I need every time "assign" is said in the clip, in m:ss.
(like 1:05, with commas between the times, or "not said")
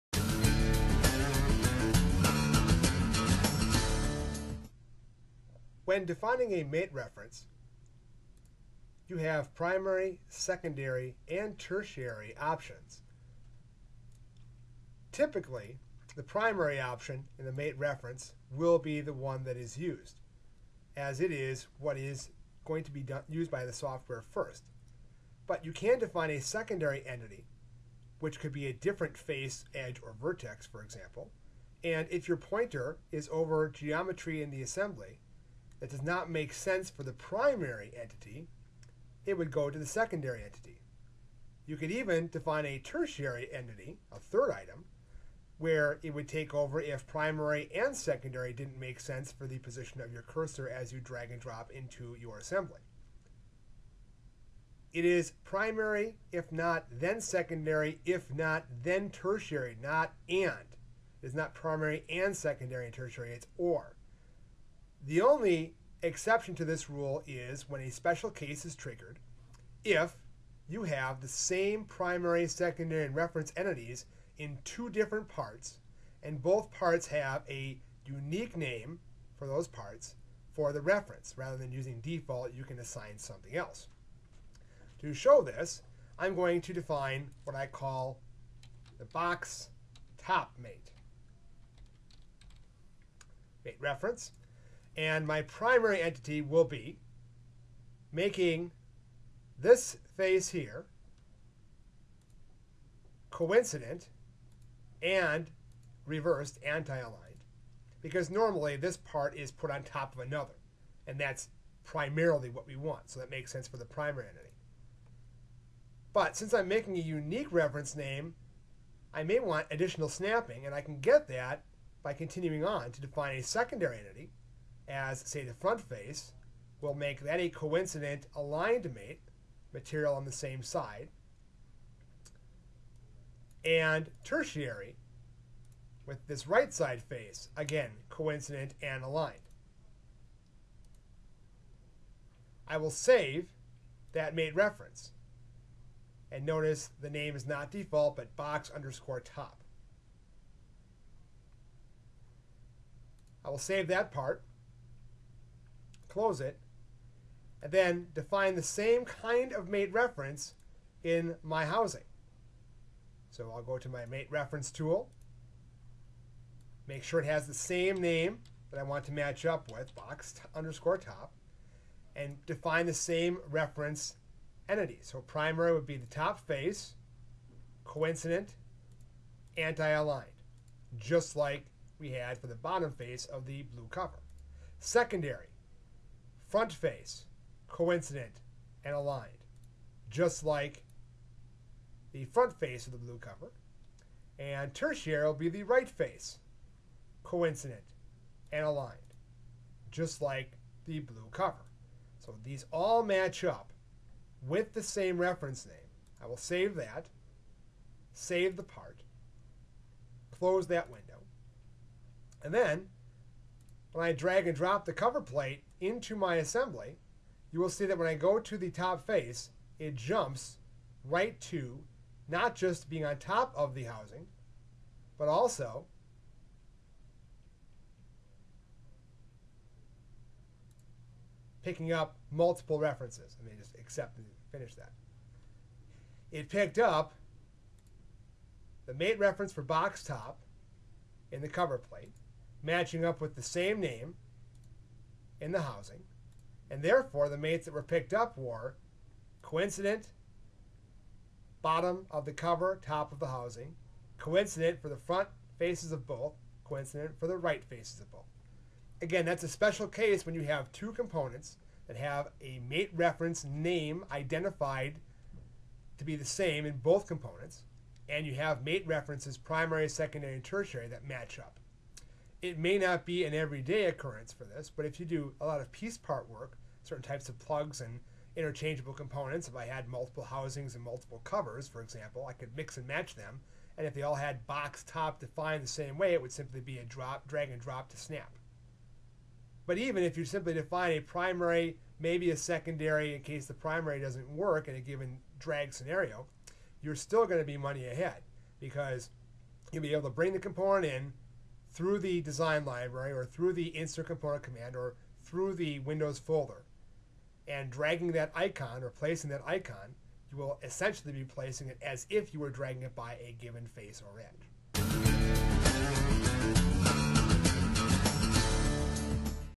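1:22.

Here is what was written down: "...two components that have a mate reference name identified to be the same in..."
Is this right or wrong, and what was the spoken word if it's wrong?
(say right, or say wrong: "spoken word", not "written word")
right.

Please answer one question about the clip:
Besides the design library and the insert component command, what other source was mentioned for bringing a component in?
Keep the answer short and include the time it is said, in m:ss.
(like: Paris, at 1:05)
Windows folder, at 5:05.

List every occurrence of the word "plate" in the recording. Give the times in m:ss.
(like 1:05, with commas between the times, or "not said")
3:35, 4:01.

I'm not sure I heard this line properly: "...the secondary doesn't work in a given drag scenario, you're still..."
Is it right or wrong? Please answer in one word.
wrong.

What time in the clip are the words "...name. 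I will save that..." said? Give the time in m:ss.
3:25.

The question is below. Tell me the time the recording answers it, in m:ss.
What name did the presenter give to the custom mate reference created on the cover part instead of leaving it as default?
1:29.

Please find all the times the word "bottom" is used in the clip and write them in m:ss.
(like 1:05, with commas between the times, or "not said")
3:02, 4:11.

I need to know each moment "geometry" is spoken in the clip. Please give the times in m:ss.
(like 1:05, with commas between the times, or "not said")
0:33.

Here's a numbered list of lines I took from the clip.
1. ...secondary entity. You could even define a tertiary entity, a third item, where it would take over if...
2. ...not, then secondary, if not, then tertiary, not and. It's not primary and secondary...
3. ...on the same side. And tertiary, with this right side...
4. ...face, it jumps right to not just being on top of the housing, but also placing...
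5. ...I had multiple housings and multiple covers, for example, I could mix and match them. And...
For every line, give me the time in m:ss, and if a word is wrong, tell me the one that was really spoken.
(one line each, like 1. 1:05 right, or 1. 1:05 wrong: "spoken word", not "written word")
1. 0:39 right
2. 0:56 right
3. 2:10 right
4. 3:39 wrong: "picking", not "placing"
5. 4:39 right.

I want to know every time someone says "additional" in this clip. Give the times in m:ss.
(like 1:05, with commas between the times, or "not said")
1:59.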